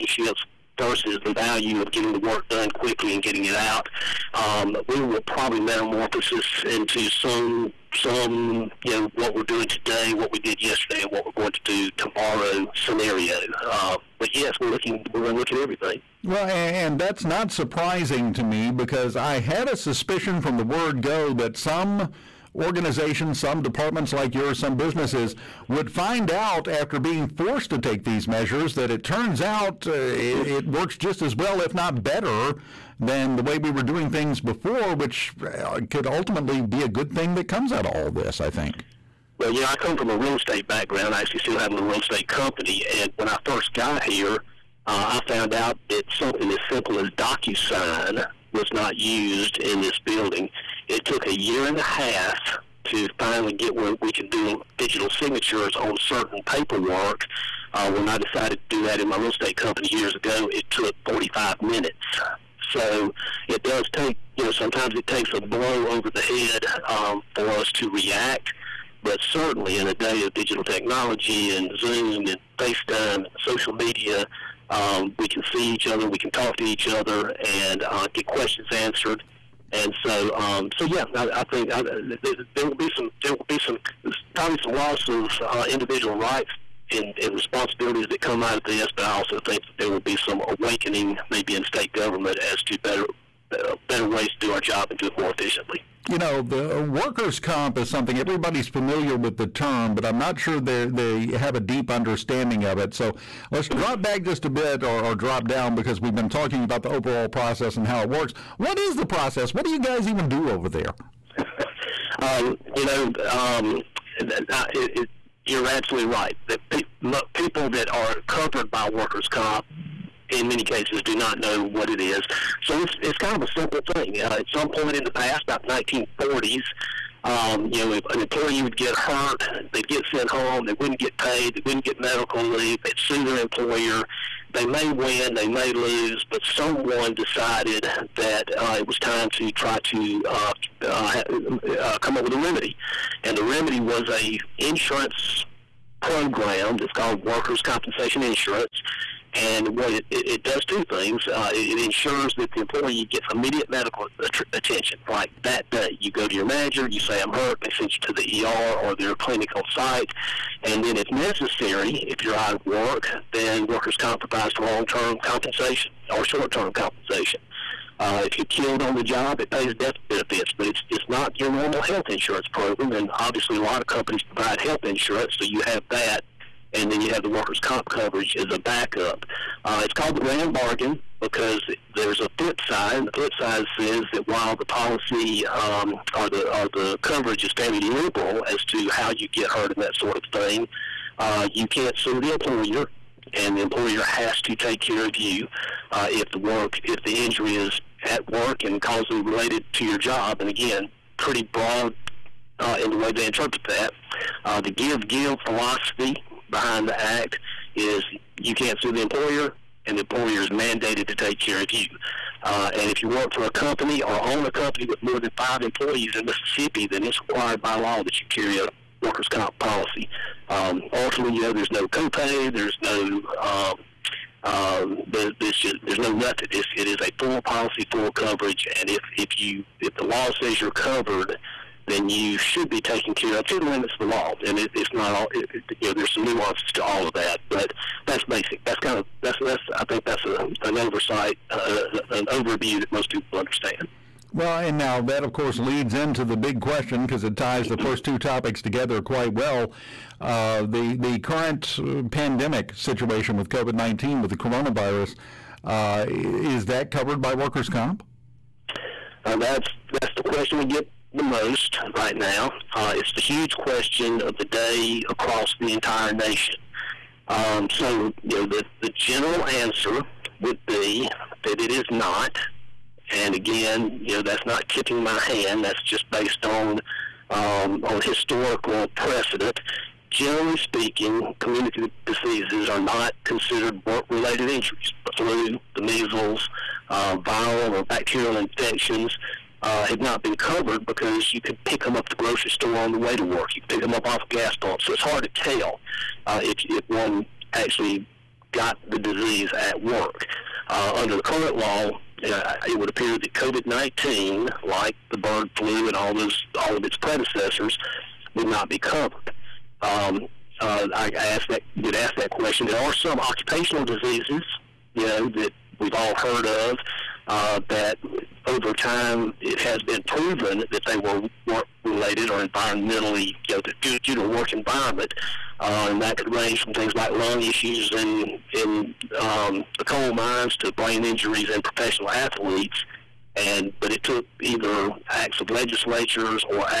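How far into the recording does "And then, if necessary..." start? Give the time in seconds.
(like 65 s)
160 s.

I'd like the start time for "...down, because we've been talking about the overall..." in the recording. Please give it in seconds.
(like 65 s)
105 s.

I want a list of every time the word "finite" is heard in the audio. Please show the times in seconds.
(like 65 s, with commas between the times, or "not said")
not said.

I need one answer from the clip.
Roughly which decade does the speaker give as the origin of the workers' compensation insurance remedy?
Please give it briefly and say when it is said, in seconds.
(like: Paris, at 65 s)
1940s, at 125 s.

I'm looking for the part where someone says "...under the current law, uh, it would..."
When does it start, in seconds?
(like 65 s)
300 s.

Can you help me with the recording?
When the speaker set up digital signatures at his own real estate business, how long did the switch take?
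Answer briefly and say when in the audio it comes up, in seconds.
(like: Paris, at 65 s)
45 minutes, at 61 s.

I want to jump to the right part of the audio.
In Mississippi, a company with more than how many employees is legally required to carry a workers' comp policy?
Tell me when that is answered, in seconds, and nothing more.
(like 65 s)
215 s.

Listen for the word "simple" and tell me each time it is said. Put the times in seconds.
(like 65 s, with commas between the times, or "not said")
46 s, 123 s.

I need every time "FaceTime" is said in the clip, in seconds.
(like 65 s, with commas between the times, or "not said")
72 s.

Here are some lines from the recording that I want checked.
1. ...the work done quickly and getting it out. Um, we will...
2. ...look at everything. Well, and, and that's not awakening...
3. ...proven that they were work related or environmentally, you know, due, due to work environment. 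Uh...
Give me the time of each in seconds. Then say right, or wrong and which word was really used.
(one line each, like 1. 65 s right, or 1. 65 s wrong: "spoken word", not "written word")
1. 2 s right
2. 15 s wrong: "surprising", not "awakening"
3. 320 s right.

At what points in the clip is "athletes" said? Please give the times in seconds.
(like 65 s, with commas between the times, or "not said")
332 s.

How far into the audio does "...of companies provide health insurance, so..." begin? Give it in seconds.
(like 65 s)
173 s.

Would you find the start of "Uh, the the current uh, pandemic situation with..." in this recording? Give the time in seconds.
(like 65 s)
250 s.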